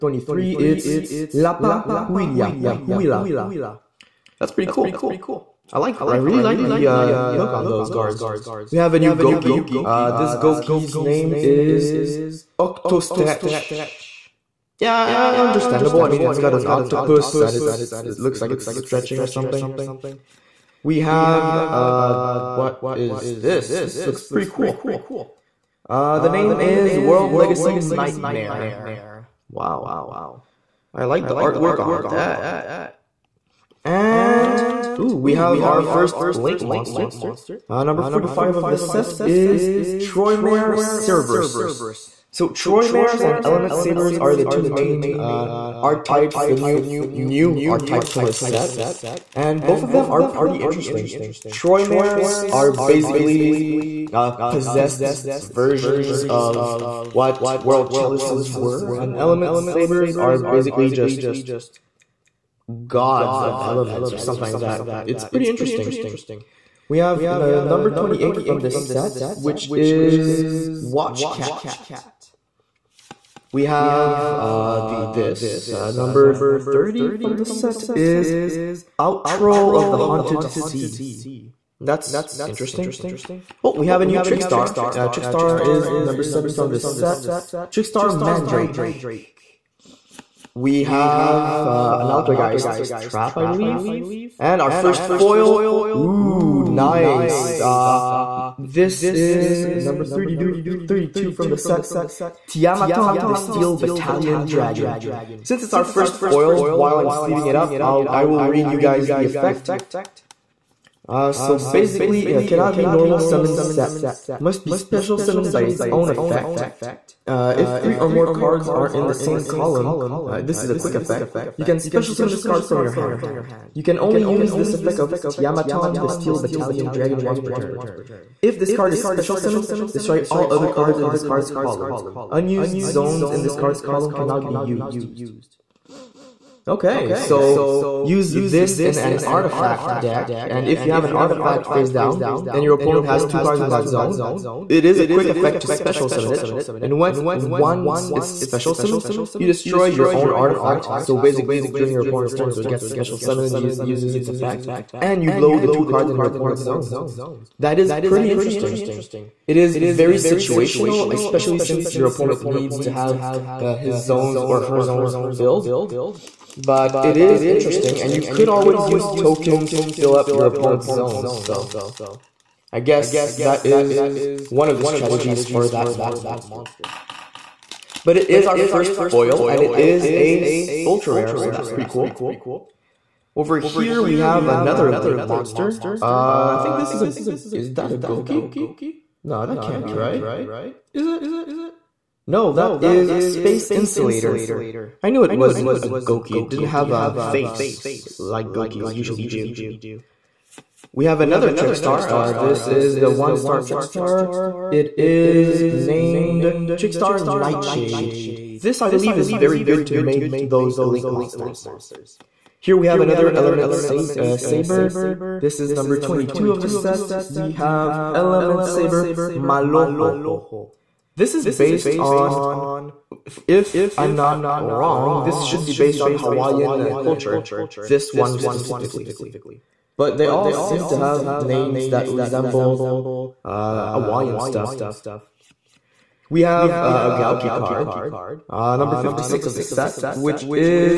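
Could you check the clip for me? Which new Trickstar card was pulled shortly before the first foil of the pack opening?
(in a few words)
Trickstar Mandrake.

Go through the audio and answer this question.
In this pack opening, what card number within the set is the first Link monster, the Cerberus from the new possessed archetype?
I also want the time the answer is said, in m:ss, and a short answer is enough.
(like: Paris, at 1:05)
45, at 0:37.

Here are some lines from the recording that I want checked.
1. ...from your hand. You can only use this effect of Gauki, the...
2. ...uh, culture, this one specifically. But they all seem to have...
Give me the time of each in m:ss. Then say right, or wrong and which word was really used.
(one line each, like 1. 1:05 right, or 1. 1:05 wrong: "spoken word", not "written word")
1. 2:02 wrong: "Tiamaton", not "Gauki"
2. 3:46 right.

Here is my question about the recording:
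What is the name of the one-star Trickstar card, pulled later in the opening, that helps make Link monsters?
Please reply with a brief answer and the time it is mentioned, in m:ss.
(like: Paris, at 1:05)
Trickstar Nightshade, at 3:26.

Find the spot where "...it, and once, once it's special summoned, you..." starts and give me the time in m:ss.
2:26.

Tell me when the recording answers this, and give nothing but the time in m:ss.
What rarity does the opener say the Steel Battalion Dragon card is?
3:00.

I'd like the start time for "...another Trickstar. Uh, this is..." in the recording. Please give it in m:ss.
3:21.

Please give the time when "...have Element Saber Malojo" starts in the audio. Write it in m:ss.
3:37.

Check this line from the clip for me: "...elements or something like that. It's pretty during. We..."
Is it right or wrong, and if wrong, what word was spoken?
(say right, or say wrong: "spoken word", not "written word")
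wrong: "interesting", not "during".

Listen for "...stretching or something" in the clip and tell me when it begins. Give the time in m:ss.
0:18.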